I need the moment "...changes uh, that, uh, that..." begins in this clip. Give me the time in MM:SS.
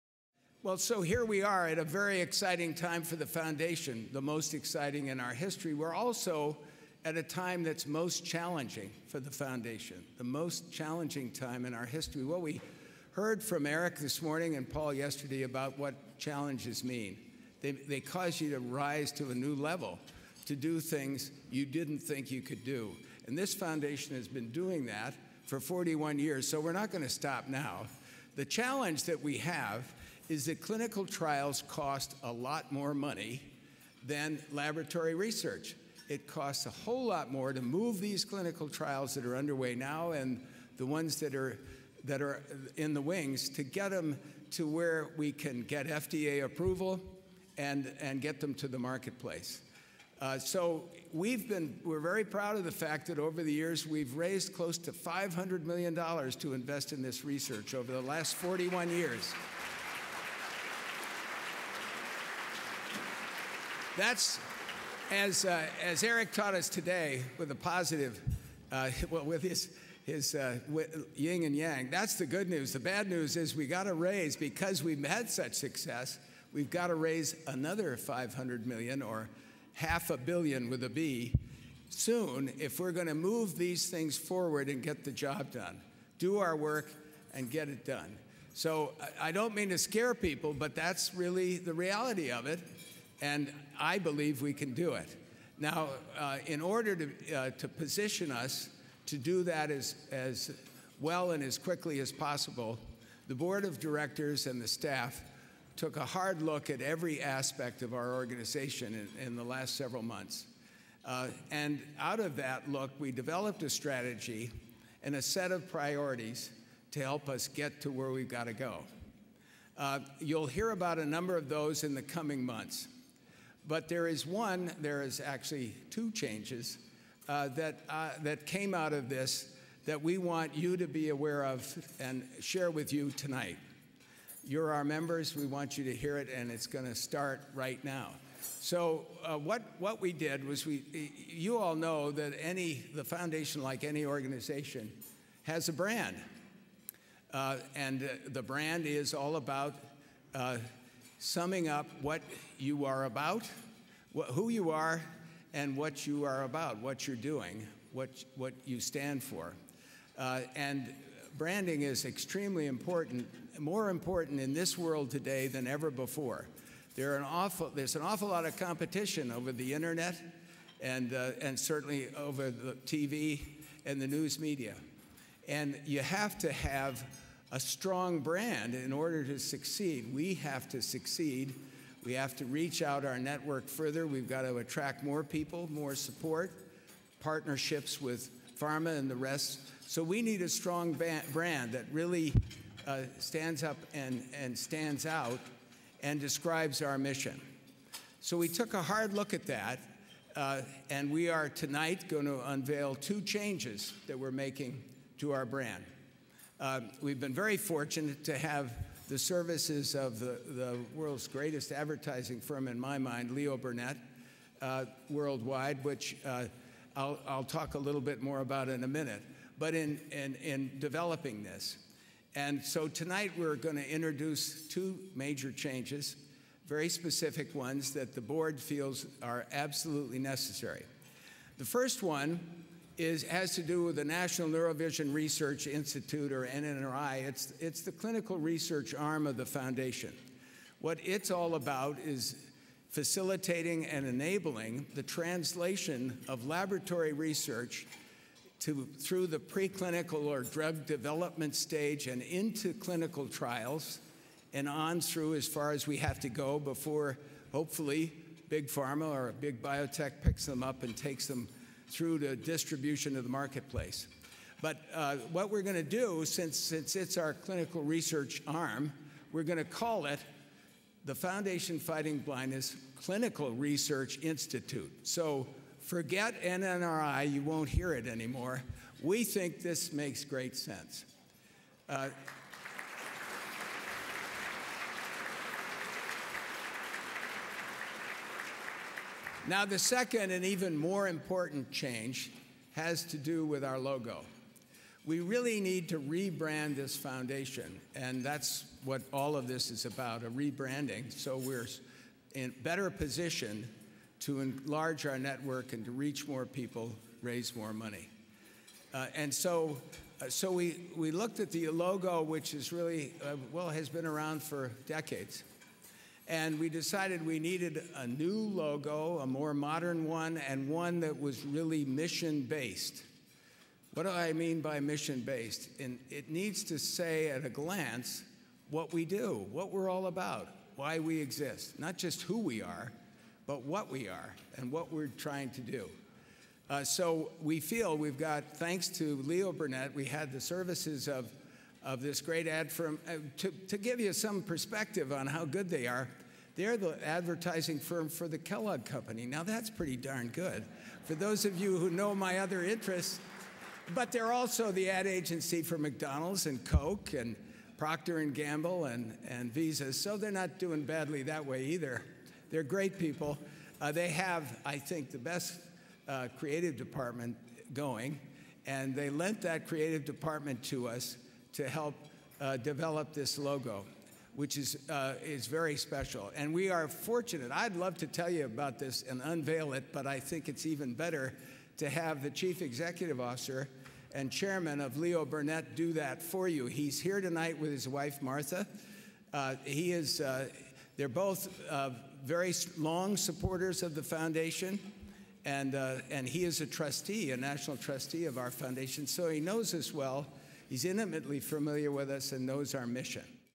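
02:06.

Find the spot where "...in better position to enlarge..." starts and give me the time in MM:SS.
05:02.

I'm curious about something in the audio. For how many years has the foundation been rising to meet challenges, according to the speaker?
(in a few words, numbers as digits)
41.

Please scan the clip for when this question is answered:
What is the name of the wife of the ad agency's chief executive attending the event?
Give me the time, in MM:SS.
06:28.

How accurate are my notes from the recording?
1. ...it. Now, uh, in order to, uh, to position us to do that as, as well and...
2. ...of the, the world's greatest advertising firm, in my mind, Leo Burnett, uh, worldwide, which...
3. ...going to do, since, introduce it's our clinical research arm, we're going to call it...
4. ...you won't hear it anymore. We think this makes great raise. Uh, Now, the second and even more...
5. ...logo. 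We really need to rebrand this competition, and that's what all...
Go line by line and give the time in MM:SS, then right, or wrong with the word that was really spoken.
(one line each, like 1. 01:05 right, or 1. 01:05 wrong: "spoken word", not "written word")
1. 01:34 right
2. 03:29 right
3. 04:25 wrong: "since", not "introduce"
4. 04:37 wrong: "sense", not "raise"
5. 04:53 wrong: "foundation", not "competition".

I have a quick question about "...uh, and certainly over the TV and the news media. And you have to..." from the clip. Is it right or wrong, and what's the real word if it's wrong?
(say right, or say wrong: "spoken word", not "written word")
right.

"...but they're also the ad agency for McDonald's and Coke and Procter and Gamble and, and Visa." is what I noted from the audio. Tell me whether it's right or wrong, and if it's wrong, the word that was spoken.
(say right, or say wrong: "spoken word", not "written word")
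right.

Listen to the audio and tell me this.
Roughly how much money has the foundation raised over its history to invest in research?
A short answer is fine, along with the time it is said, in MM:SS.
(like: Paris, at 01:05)
close to $500 million, at 00:54.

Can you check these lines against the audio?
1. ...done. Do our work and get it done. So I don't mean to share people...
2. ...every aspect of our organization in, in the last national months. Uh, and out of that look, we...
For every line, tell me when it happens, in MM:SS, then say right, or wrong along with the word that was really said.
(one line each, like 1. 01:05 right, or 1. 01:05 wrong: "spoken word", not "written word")
1. 01:25 wrong: "scare", not "share"
2. 01:46 wrong: "several", not "national".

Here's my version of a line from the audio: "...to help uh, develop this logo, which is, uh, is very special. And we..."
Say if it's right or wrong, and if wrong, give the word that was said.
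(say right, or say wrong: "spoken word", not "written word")
right.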